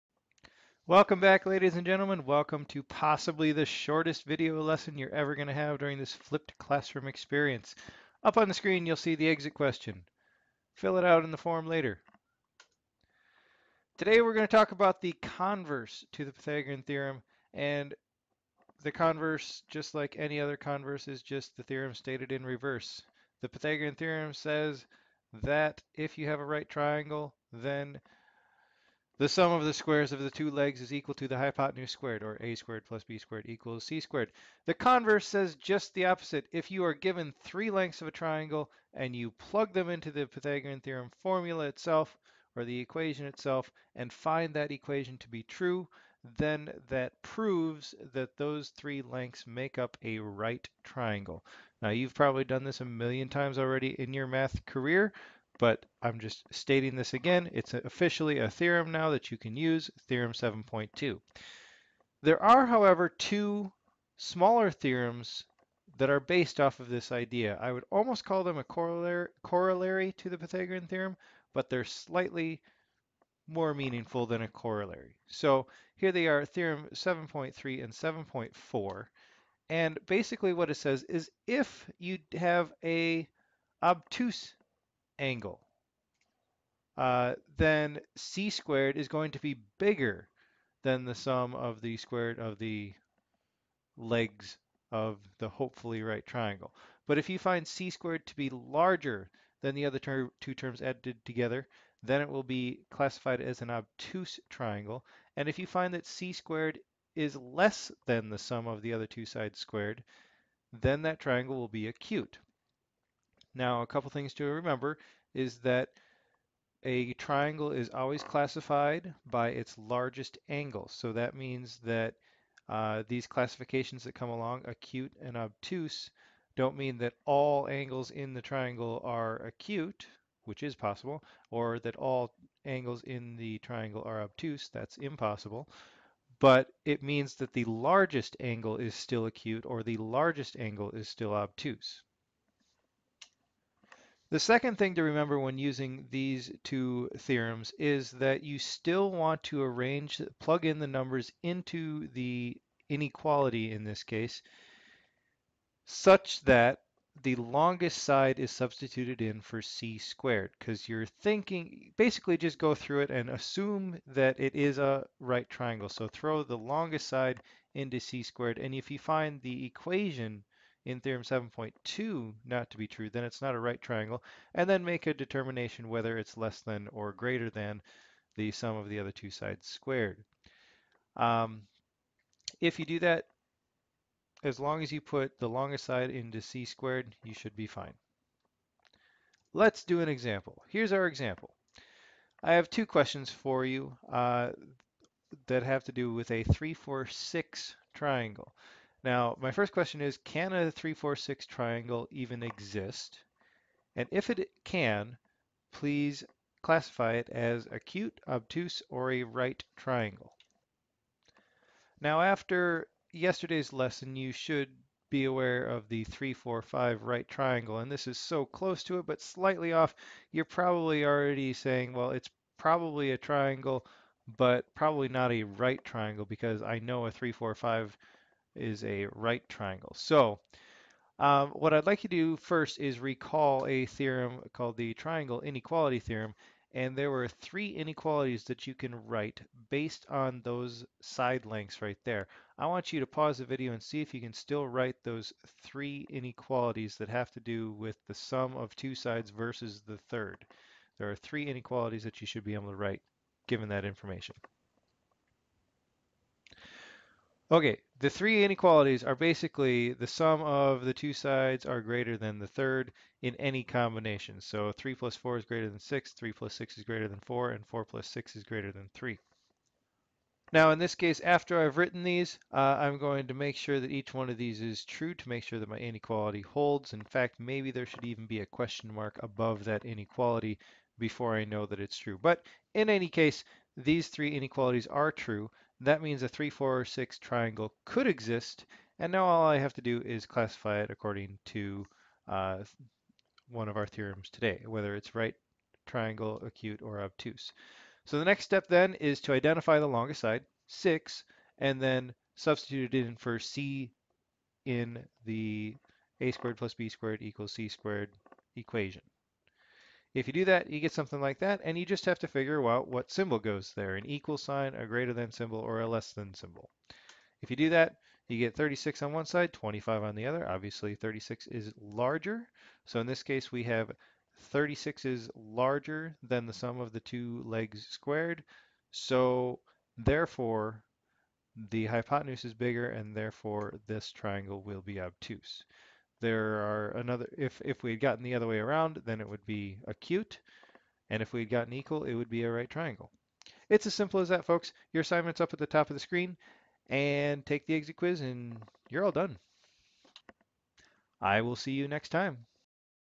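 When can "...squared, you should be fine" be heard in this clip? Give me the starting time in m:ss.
3:06.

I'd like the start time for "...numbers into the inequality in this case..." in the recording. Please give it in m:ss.
2:30.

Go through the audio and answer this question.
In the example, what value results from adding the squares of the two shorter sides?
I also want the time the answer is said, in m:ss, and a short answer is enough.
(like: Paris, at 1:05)
25, at 5:19.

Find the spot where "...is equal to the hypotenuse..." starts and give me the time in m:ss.
0:30.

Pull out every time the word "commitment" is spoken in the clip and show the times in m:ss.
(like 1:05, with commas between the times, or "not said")
not said.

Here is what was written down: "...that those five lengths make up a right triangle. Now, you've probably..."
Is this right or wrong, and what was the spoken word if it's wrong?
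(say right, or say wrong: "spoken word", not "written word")
wrong: "three", not "five".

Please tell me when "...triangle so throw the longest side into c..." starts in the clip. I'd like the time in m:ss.
2:45.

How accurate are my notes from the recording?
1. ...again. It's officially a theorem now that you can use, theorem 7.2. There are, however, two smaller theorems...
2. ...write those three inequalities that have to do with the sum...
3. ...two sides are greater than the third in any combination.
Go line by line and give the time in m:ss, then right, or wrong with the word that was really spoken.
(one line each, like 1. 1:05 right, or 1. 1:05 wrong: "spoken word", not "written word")
1. 0:57 right
2. 4:04 right
3. 4:20 right.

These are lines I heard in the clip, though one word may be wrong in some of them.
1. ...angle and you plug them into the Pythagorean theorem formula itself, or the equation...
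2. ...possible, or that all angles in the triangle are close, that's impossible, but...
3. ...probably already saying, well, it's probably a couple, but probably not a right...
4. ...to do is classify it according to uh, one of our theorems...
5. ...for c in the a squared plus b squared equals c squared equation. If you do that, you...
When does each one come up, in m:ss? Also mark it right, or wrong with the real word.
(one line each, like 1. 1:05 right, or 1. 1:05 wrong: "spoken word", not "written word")
1. 0:38 wrong: "triangle", not "angle"
2. 2:10 wrong: "obtuse", not "close"
3. 3:40 wrong: "triangle", not "couple"
4. 4:49 right
5. 5:03 right.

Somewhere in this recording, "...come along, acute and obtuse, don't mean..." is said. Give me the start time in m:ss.
2:04.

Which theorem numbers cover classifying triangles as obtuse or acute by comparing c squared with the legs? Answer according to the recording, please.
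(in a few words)
7.3 and 7.4.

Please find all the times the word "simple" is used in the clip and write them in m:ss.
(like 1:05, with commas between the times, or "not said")
5:43.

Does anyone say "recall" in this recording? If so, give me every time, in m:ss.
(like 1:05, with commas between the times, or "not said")
3:52.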